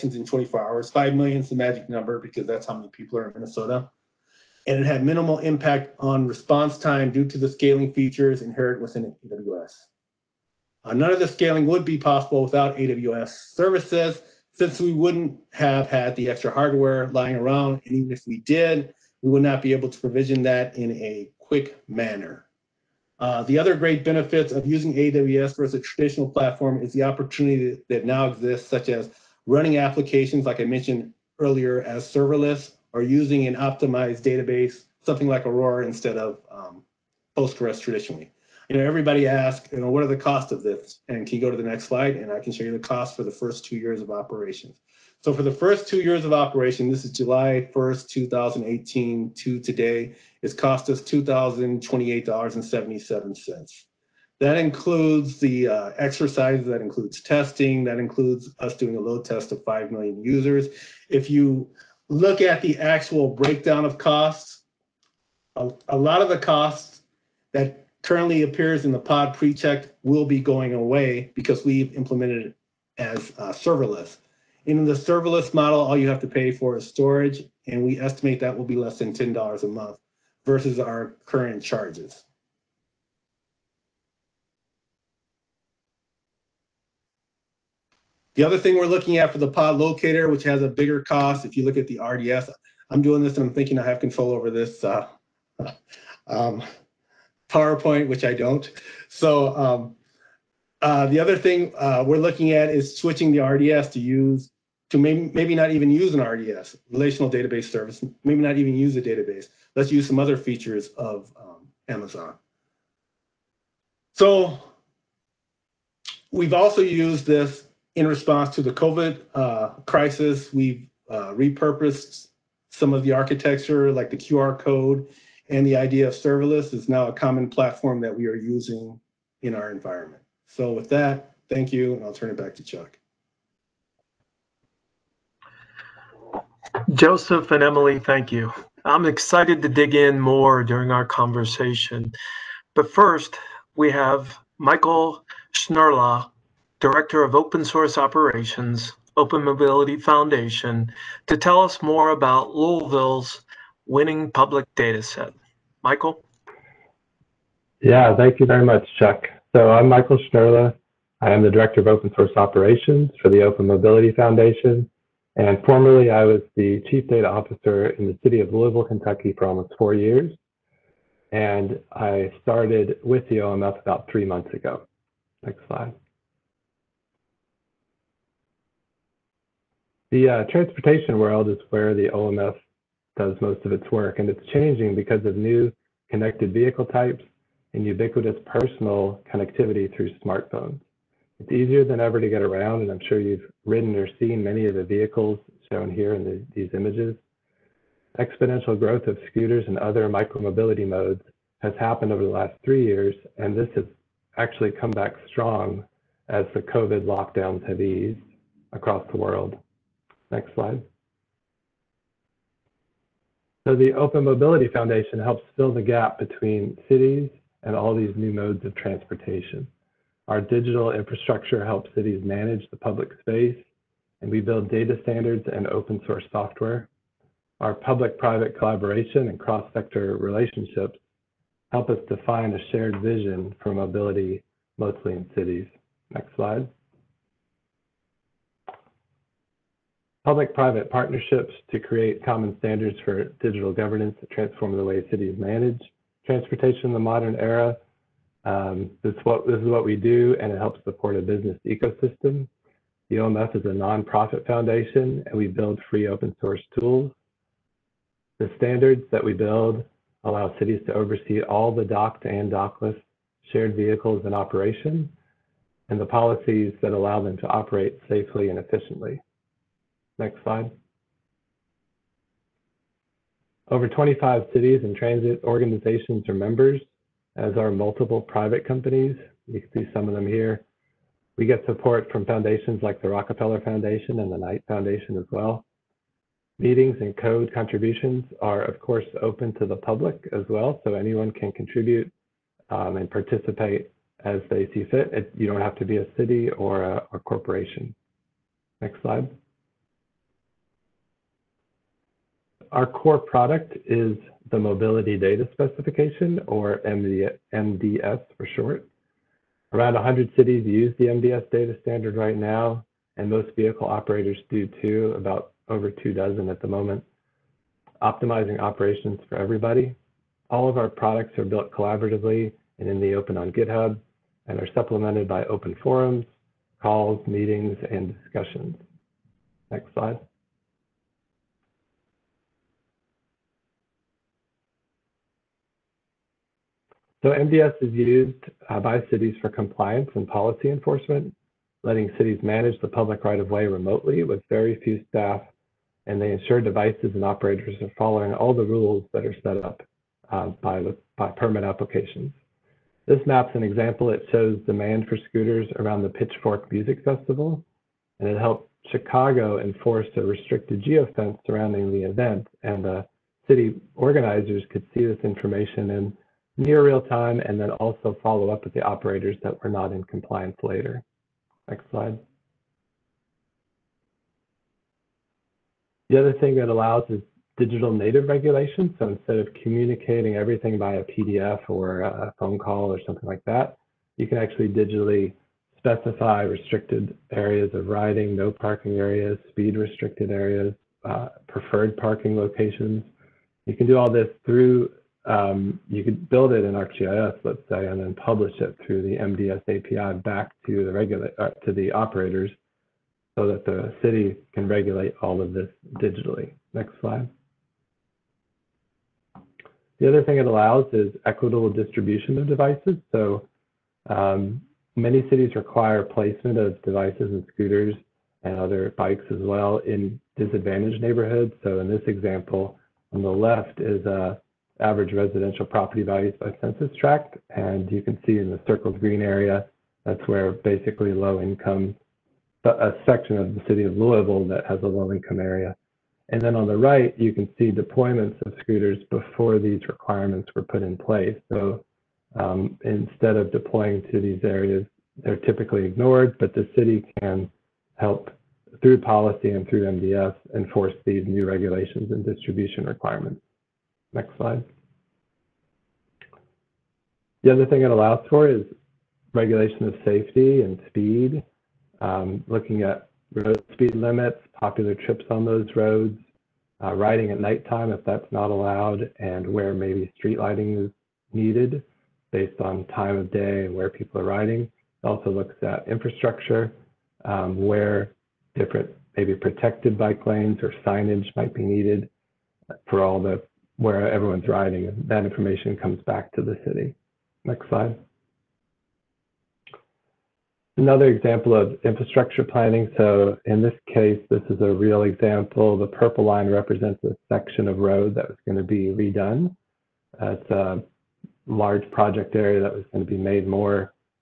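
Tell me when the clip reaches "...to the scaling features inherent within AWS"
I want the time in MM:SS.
00:07.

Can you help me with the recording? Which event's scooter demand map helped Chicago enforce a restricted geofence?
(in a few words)
Pitchfork Music Festival.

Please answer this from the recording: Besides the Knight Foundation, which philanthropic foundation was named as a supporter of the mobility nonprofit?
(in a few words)
Rockefeller Foundation.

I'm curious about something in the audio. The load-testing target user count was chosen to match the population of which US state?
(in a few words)
Minnesota.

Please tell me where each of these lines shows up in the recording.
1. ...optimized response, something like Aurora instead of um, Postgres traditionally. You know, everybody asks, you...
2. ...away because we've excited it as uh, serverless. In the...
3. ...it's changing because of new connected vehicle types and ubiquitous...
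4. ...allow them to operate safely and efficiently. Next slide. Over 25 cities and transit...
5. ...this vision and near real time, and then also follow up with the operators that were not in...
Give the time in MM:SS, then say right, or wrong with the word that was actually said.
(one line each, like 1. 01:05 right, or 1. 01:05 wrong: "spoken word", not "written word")
1. 00:33 wrong: "database", not "response"
2. 01:10 wrong: "implemented", not "excited"
3. 03:04 right
4. 04:26 right
5. 06:05 wrong: "information", not "vision".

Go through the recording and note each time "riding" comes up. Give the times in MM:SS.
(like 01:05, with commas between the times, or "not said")
06:27, 07:46, 07:54, 08:04.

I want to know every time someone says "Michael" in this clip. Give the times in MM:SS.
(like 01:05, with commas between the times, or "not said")
02:24, 02:35, 02:39.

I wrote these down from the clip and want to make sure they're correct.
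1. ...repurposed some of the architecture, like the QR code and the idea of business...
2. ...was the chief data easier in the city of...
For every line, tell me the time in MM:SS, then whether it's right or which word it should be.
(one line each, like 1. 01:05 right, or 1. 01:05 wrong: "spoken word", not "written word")
1. 02:01 wrong: "serverless", not "business"
2. 02:46 wrong: "officer", not "easier".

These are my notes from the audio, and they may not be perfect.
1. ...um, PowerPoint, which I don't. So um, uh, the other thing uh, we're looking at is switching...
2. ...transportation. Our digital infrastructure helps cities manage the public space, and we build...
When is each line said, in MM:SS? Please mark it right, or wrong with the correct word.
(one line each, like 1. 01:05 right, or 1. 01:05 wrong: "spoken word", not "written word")
1. 01:36 right
2. 03:38 right.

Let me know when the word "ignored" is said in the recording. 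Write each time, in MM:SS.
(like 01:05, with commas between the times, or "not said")
07:25.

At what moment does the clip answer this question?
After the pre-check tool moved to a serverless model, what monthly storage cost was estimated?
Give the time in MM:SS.
01:18.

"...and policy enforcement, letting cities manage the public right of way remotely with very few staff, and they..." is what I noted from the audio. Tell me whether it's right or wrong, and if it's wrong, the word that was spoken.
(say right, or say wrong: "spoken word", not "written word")
right.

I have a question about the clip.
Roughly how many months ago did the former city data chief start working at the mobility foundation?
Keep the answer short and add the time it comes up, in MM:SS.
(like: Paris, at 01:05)
3 months, at 02:54.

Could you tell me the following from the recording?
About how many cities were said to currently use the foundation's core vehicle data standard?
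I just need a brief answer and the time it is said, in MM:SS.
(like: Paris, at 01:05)
100, at 05:09.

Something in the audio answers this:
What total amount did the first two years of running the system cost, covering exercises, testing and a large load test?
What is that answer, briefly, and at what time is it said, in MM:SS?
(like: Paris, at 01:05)
$2,028.77, at 00:51.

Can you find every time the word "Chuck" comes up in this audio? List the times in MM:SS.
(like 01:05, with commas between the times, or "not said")
02:12, 02:38.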